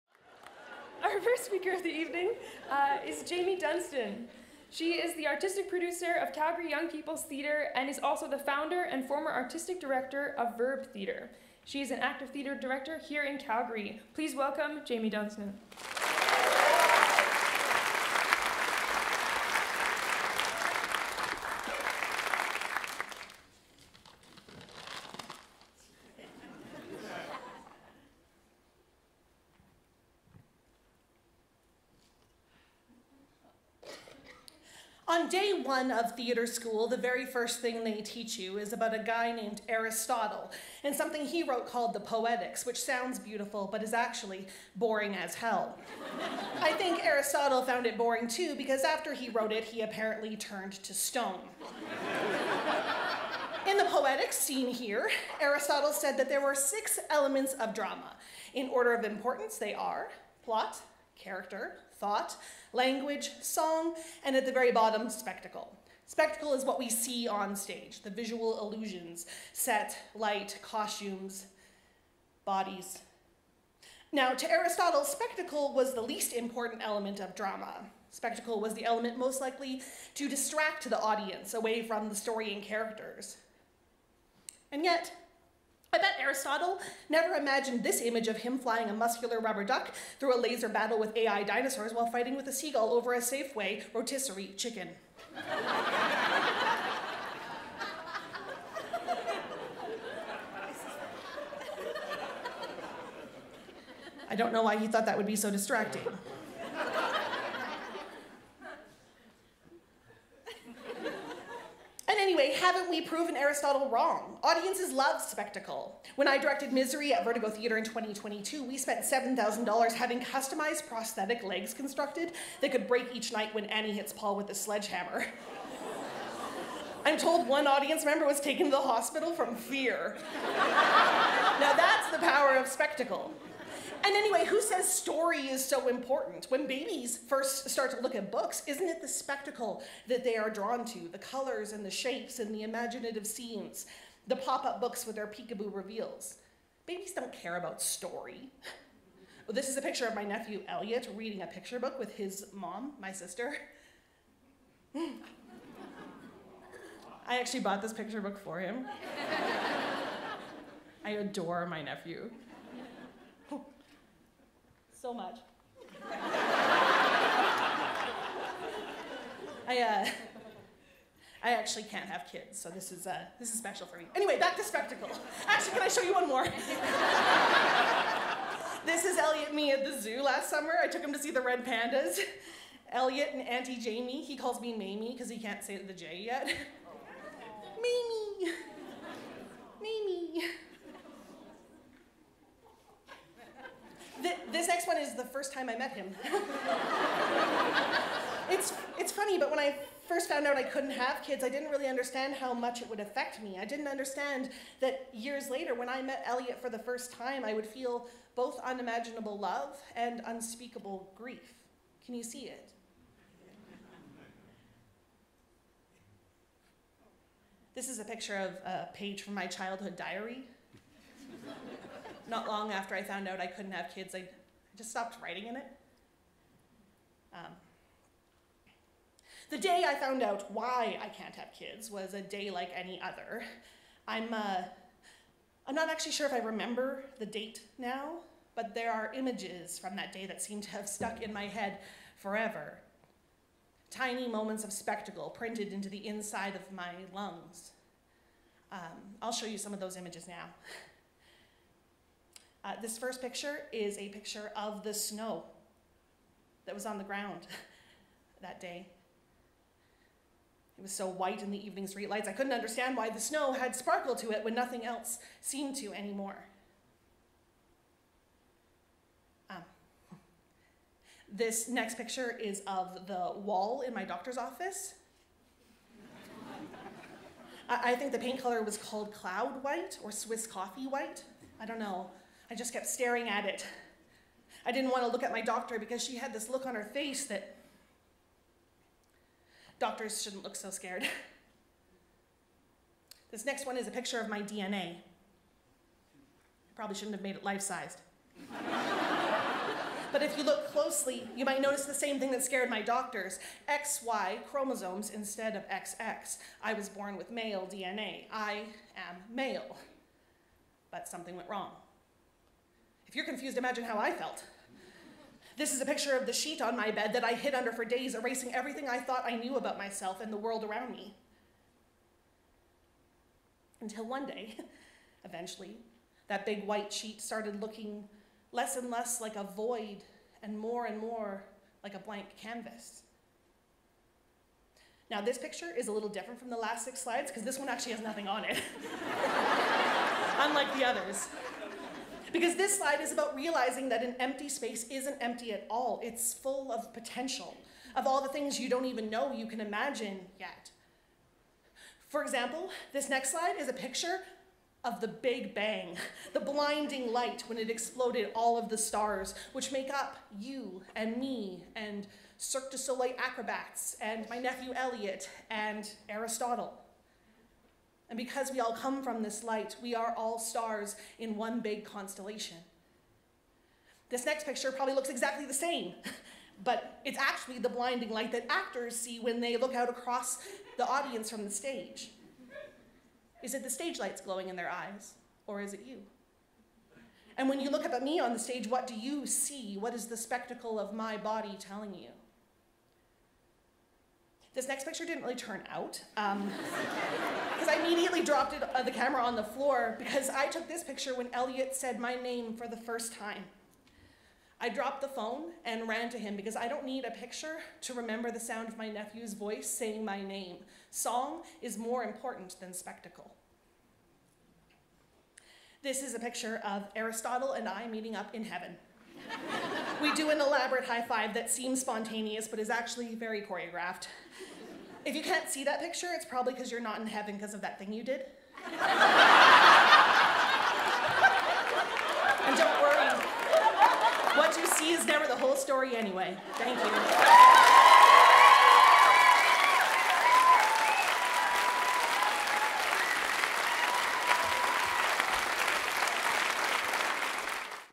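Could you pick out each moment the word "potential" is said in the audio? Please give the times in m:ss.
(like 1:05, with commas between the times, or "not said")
5:46.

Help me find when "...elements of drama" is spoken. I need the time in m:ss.
0:57.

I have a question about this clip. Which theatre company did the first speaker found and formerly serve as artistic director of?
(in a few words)
Verb Theatre.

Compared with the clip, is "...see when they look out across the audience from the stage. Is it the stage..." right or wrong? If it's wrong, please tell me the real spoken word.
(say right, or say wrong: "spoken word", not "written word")
right.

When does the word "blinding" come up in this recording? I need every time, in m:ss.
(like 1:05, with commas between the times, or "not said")
5:56, 6:17.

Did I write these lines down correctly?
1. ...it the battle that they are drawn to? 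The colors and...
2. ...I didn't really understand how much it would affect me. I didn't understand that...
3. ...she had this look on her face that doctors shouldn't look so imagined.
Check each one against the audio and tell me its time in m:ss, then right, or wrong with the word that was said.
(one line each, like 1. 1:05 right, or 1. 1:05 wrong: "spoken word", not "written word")
1. 2:18 wrong: "spectacle", not "battle"
2. 3:21 right
3. 4:46 wrong: "scared", not "imagined".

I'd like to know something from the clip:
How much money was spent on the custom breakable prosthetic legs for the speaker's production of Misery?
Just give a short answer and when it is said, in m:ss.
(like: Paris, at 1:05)
$7,000, at 1:59.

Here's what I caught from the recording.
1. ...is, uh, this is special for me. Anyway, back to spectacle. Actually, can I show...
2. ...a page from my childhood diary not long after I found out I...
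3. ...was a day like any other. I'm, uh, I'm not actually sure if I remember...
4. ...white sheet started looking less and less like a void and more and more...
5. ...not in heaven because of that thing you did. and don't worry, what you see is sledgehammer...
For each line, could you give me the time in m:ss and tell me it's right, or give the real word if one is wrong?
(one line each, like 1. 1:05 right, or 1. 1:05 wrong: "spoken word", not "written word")
1. 2:52 right
2. 3:38 right
3. 3:51 right
4. 5:26 right
5. 7:06 wrong: "never", not "sledgehammer".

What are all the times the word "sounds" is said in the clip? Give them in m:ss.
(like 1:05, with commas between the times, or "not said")
0:42, 6:48.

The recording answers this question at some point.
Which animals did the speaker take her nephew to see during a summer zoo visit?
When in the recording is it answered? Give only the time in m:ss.
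3:01.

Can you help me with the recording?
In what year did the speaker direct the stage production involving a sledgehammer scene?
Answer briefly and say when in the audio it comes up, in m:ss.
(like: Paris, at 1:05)
2022, at 1:57.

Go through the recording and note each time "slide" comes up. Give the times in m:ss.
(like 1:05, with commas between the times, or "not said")
5:37, 5:42, 5:53.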